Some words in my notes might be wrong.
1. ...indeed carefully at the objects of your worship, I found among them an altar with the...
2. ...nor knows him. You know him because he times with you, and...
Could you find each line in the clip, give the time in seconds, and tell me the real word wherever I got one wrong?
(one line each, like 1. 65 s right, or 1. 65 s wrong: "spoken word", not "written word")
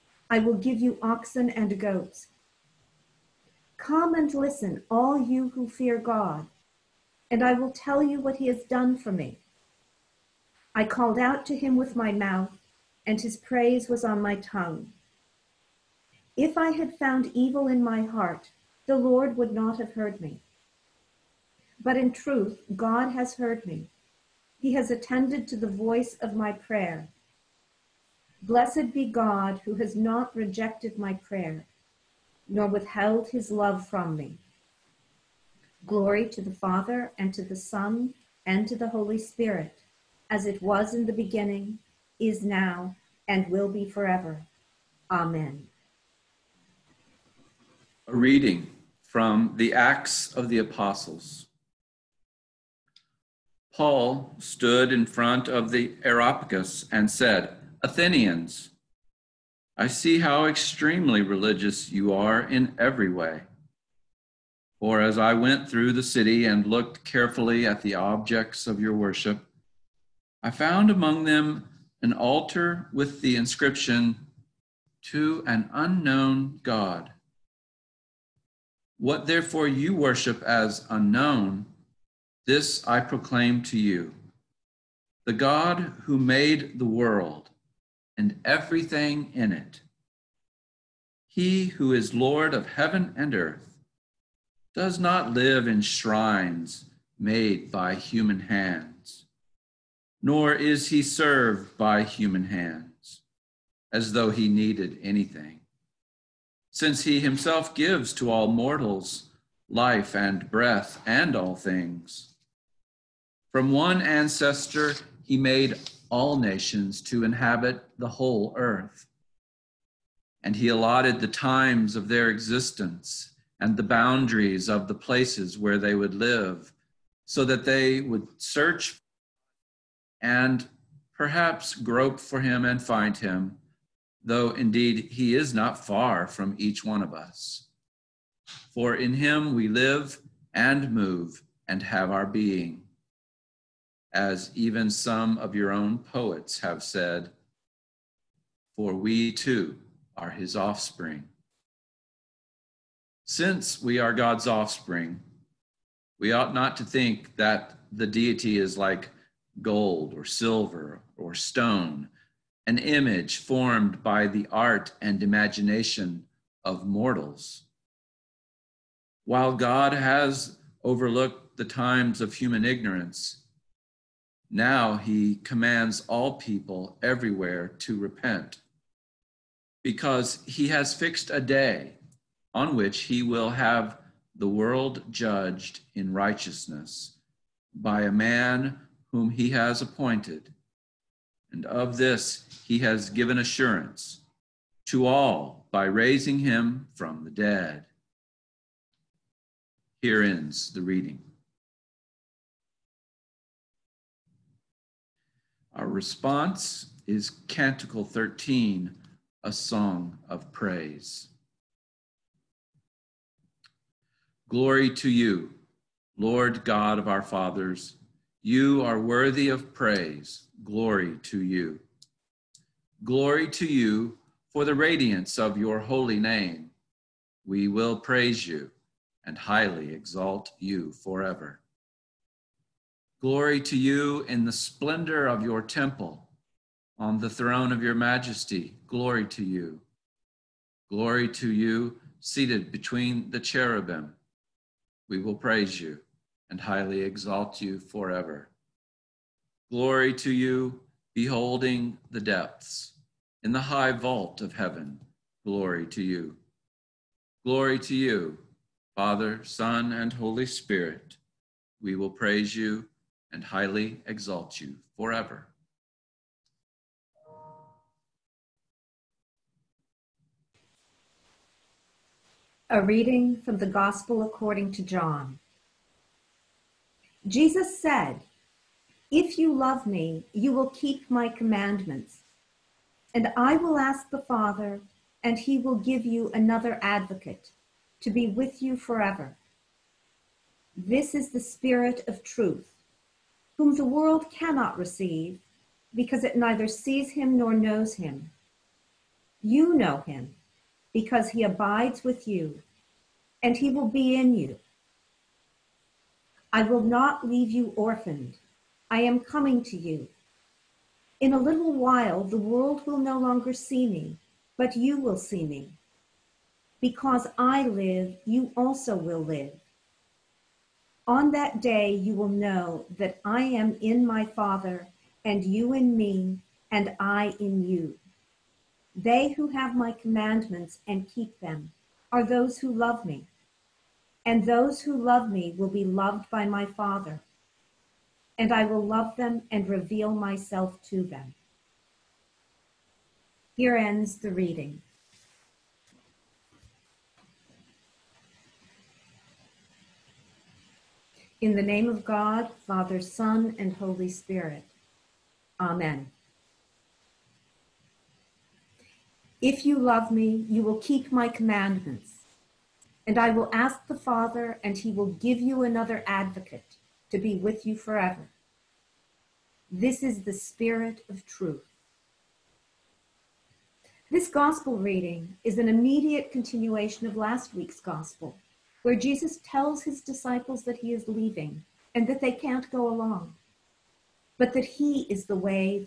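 1. 66 s wrong: "looked", not "indeed"
2. 297 s wrong: "abides", not "times".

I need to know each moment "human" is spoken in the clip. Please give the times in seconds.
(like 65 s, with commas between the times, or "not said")
97 s, 102 s, 172 s.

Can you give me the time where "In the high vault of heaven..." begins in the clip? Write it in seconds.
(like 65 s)
253 s.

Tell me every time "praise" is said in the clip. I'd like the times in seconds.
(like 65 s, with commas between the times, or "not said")
13 s, 210 s, 219 s, 228 s, 245 s, 262 s.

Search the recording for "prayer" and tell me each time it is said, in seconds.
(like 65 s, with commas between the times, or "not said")
26 s, 31 s.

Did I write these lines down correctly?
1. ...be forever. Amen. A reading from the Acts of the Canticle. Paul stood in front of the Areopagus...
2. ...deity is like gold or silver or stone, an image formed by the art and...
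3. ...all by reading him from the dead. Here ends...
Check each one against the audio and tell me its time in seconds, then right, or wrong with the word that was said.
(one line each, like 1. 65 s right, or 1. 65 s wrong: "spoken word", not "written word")
1. 43 s wrong: "Apostles", not "Canticle"
2. 158 s right
3. 195 s wrong: "raising", not "reading".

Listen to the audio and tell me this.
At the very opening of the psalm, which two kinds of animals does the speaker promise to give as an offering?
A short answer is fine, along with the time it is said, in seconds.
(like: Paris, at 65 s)
oxen and goats, at 1 s.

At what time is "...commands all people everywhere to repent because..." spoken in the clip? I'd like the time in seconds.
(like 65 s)
175 s.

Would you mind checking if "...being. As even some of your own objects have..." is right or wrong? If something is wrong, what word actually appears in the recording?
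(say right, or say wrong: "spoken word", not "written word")
wrong: "poets", not "objects".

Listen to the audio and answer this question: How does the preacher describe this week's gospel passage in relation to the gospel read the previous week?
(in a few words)
immediate continuation.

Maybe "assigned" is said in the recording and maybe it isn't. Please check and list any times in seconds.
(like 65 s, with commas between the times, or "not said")
not said.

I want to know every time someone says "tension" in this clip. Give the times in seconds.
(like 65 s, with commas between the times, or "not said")
not said.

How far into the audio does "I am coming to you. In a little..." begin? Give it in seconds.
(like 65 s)
308 s.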